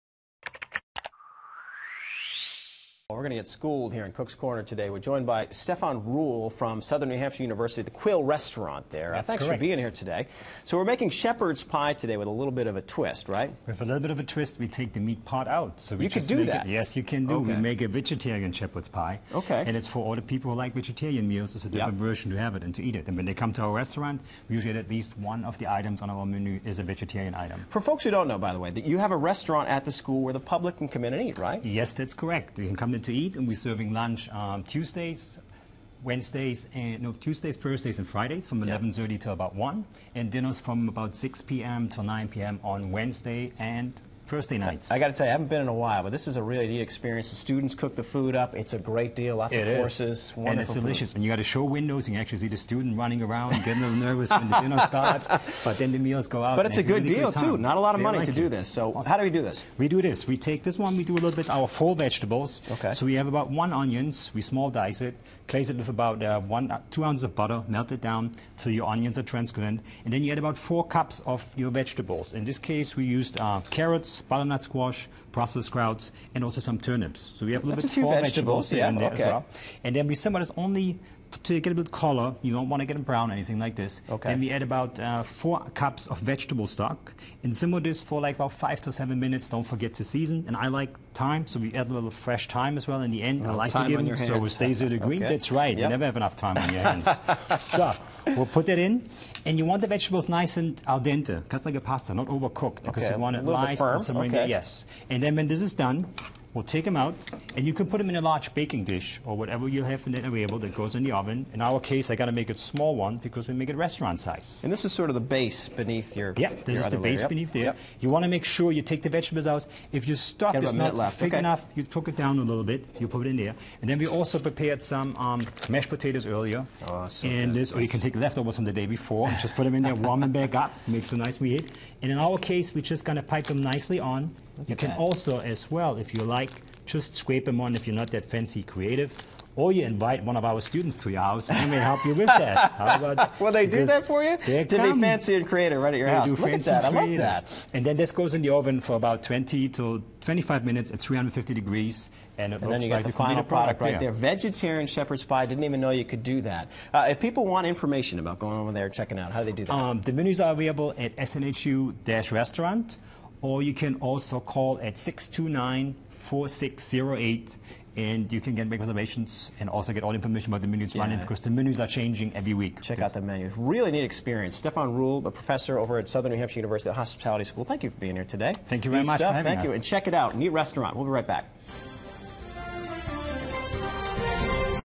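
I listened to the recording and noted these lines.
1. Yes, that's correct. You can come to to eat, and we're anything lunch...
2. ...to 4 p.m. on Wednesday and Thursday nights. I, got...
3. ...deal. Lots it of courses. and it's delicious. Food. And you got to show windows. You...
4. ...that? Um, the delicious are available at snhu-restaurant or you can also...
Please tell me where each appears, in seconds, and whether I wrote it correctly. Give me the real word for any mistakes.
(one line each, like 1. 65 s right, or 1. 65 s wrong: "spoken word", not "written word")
1. 31 s wrong: "serving", not "anything"
2. 41 s wrong: "9", not "4"
3. 49 s right
4. 159 s wrong: "menus", not "delicious".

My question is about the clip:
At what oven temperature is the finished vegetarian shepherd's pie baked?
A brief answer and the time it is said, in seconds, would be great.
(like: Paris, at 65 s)
350 degrees, at 151 s.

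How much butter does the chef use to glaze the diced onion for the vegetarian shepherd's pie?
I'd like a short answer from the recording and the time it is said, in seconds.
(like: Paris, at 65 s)
2 ounces, at 66 s.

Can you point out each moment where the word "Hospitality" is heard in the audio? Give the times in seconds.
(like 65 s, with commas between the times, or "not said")
176 s.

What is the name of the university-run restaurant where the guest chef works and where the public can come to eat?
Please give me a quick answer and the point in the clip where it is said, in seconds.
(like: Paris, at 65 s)
Quill Restaurant, at 7 s.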